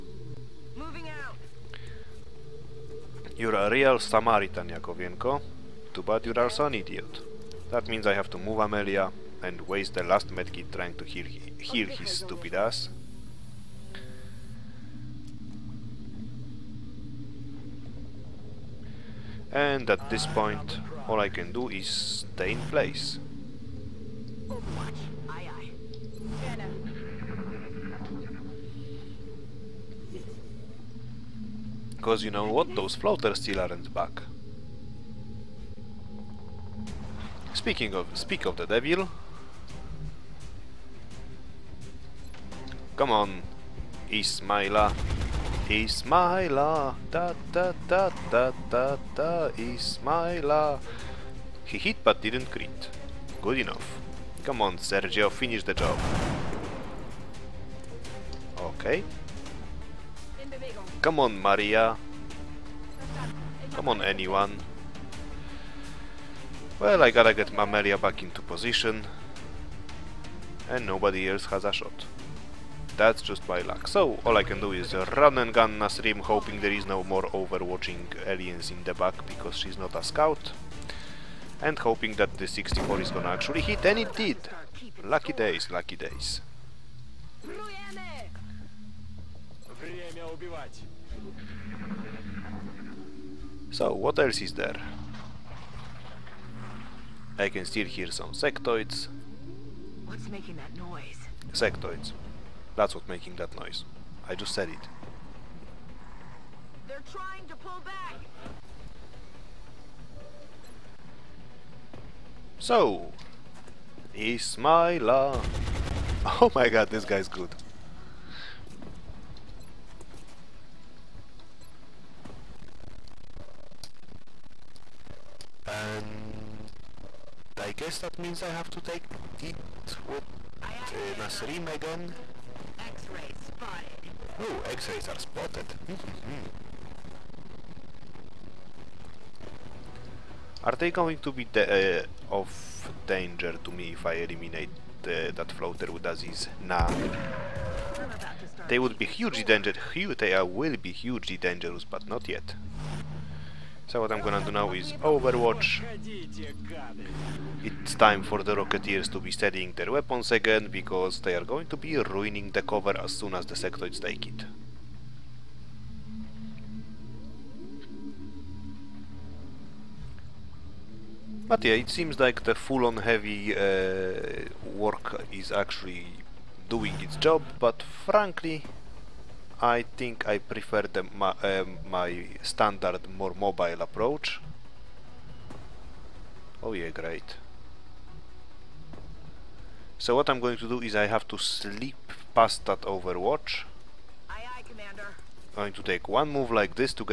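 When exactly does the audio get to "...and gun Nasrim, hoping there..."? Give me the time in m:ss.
1:15.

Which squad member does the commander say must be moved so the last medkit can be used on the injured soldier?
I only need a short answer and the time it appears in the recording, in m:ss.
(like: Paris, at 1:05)
Amelia, at 0:08.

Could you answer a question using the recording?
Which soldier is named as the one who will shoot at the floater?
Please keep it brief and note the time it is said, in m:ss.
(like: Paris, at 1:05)
Aziz, at 2:26.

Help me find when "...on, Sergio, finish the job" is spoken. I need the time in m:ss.
0:54.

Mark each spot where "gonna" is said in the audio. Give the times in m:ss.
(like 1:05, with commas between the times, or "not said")
1:23, 2:34.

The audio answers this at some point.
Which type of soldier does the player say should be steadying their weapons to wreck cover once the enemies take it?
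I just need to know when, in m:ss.
2:38.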